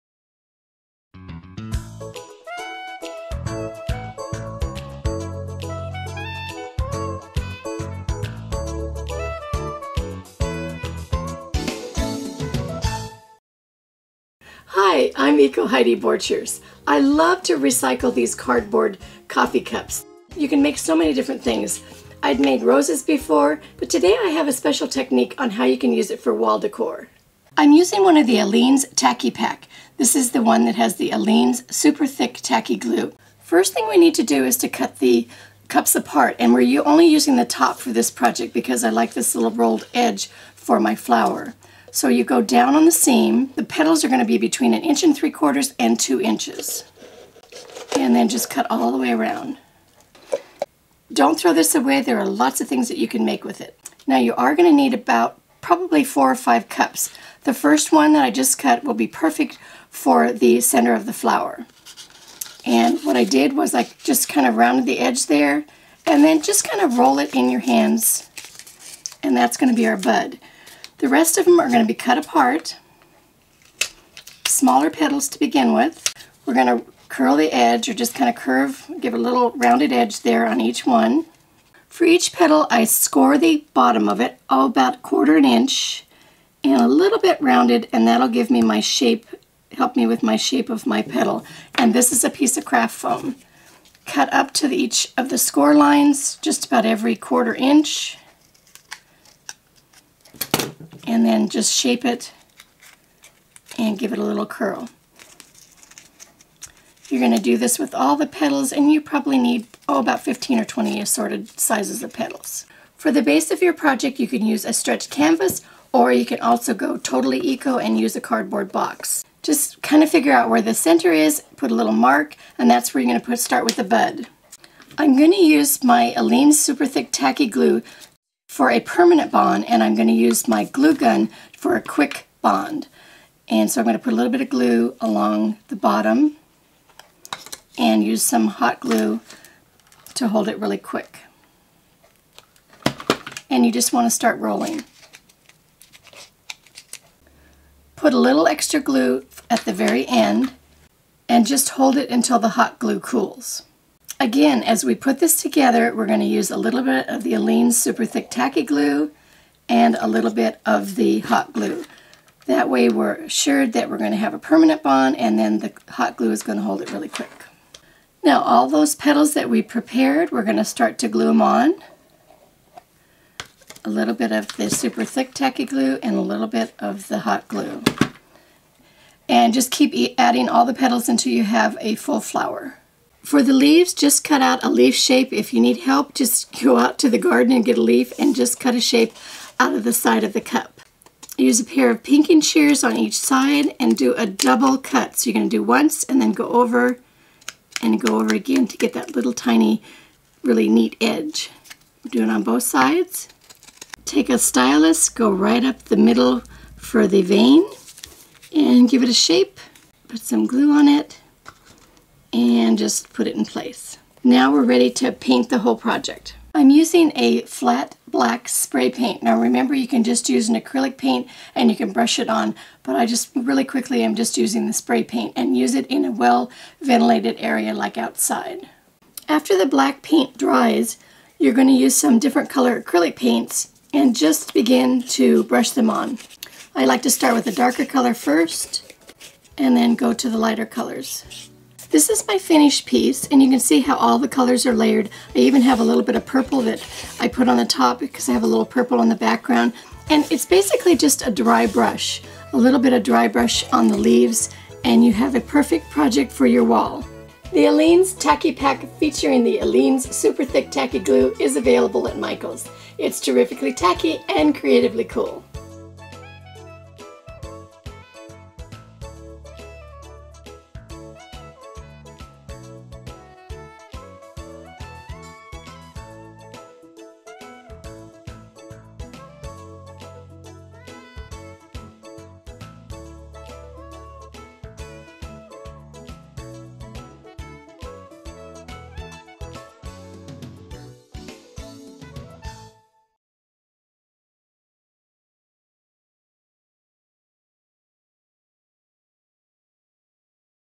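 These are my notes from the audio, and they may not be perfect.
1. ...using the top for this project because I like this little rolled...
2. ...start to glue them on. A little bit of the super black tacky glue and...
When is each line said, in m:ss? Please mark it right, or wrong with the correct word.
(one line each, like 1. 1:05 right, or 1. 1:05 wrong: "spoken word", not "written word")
1. 0:37 right
2. 2:50 wrong: "thick", not "black".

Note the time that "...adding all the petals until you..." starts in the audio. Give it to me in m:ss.
3:00.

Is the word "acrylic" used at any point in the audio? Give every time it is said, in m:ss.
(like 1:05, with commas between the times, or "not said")
3:40, 3:52.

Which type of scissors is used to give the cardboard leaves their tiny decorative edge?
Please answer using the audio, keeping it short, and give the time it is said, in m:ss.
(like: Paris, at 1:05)
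pinking shears, at 3:12.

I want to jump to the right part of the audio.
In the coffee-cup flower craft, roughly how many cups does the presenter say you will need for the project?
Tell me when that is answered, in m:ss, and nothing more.
0:56.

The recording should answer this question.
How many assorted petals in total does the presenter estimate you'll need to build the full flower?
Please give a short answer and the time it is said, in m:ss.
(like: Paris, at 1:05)
15 or 20, at 1:50.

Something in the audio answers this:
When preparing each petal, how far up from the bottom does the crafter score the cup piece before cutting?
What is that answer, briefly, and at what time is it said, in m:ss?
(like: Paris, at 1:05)
1/4 inch, at 1:24.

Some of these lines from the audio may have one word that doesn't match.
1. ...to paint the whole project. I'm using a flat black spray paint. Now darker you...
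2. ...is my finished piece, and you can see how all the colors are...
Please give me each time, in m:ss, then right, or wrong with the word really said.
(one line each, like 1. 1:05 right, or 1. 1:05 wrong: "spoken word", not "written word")
1. 3:34 wrong: "remember", not "darker"
2. 4:02 right.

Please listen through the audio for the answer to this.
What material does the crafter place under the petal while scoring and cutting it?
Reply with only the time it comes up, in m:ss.
1:32.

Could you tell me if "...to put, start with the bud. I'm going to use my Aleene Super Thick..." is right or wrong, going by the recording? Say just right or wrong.
right.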